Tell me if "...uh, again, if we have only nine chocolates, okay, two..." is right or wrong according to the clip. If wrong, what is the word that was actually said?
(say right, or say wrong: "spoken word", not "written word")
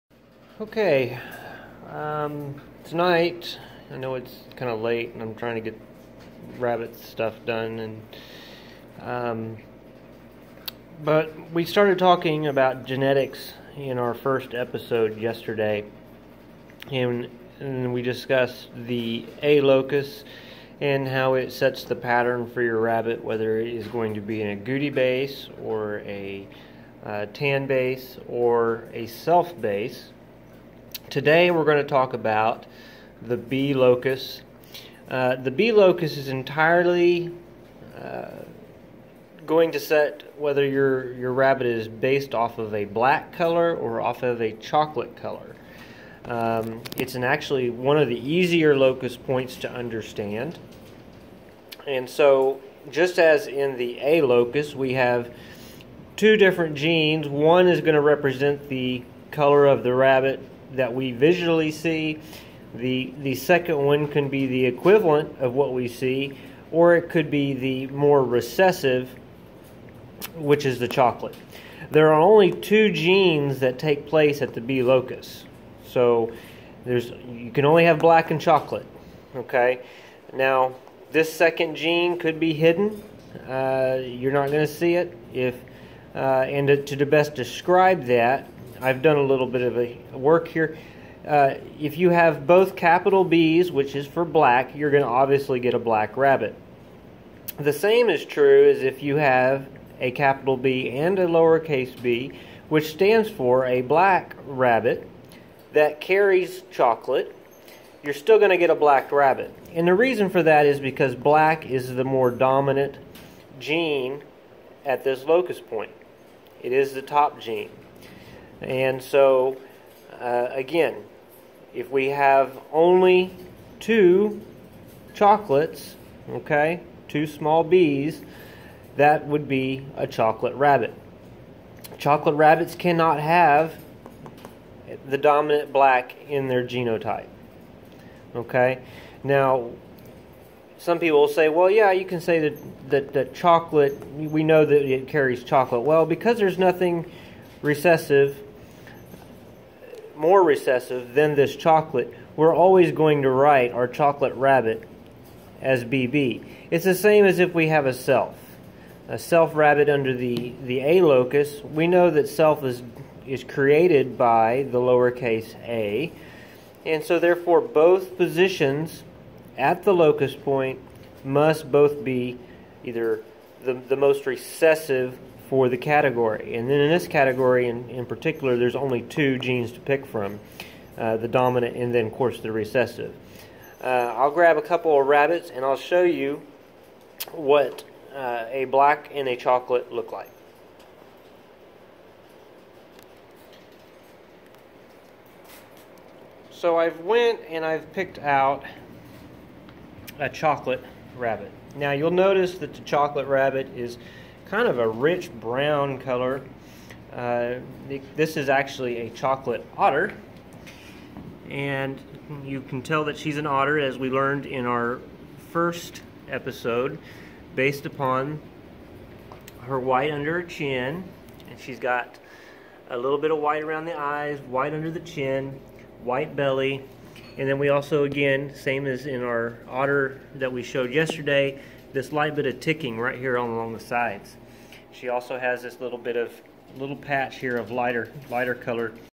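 wrong: "two", not "nine".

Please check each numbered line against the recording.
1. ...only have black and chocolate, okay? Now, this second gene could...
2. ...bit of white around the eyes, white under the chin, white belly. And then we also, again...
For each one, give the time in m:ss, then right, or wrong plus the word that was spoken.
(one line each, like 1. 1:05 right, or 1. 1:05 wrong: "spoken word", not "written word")
1. 1:17 right
2. 3:43 right.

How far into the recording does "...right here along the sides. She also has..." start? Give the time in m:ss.
3:52.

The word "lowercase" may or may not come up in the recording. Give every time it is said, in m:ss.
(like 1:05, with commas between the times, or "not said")
1:41, 2:44.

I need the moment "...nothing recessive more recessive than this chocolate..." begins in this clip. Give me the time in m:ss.
2:26.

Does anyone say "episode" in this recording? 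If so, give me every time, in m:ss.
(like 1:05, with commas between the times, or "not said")
0:14, 3:36.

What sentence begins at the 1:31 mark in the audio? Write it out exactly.
Uh, if you have both capital B's, which is for black, you're going to obviously get a black rabbit.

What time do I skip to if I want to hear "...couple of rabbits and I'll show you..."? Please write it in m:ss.
3:04.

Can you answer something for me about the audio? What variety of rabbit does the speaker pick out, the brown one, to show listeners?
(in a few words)
Chocolate otter.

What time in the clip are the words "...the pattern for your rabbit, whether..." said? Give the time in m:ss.
0:21.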